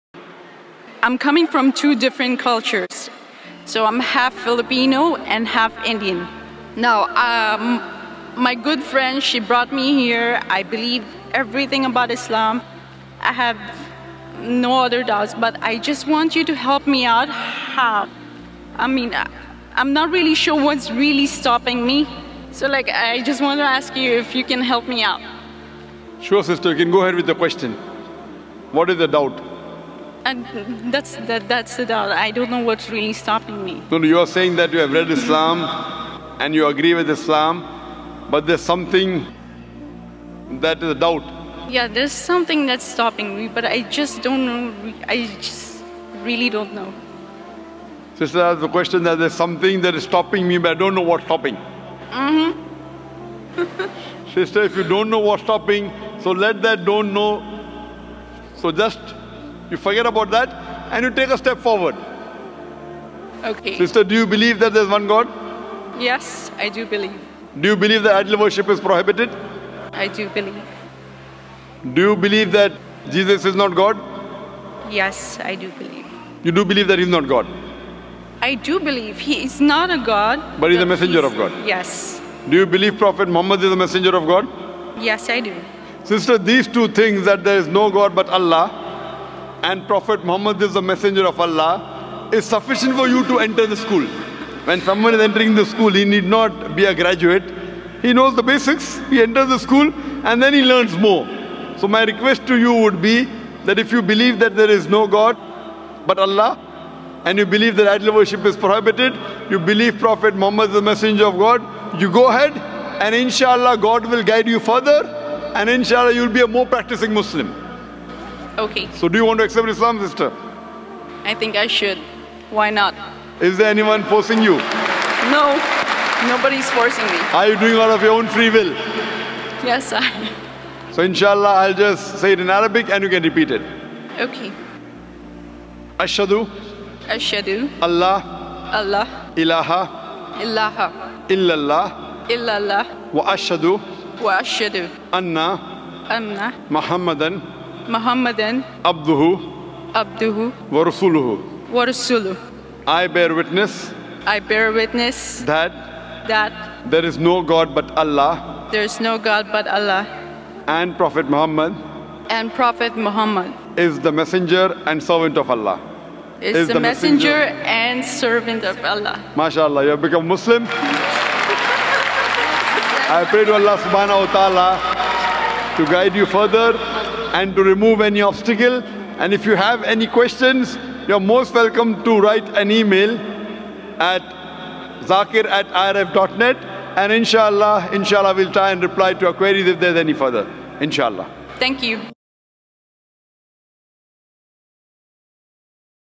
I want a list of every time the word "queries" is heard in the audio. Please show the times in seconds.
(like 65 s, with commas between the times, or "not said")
189 s.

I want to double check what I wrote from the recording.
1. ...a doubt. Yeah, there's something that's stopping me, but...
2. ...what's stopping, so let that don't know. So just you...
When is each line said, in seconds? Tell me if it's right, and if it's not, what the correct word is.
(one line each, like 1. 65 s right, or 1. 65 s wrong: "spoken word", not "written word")
1. 40 s right
2. 55 s right.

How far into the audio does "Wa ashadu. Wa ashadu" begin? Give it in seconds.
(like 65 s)
143 s.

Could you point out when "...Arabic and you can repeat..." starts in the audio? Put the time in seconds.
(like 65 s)
132 s.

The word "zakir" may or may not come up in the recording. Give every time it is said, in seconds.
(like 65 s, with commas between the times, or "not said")
185 s.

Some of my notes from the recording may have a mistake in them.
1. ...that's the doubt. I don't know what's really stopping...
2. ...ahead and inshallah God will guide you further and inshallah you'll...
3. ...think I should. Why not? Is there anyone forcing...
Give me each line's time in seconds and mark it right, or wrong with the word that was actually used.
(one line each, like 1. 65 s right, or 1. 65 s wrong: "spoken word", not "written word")
1. 31 s right
2. 112 s right
3. 121 s right.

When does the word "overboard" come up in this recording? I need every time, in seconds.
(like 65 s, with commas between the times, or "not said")
not said.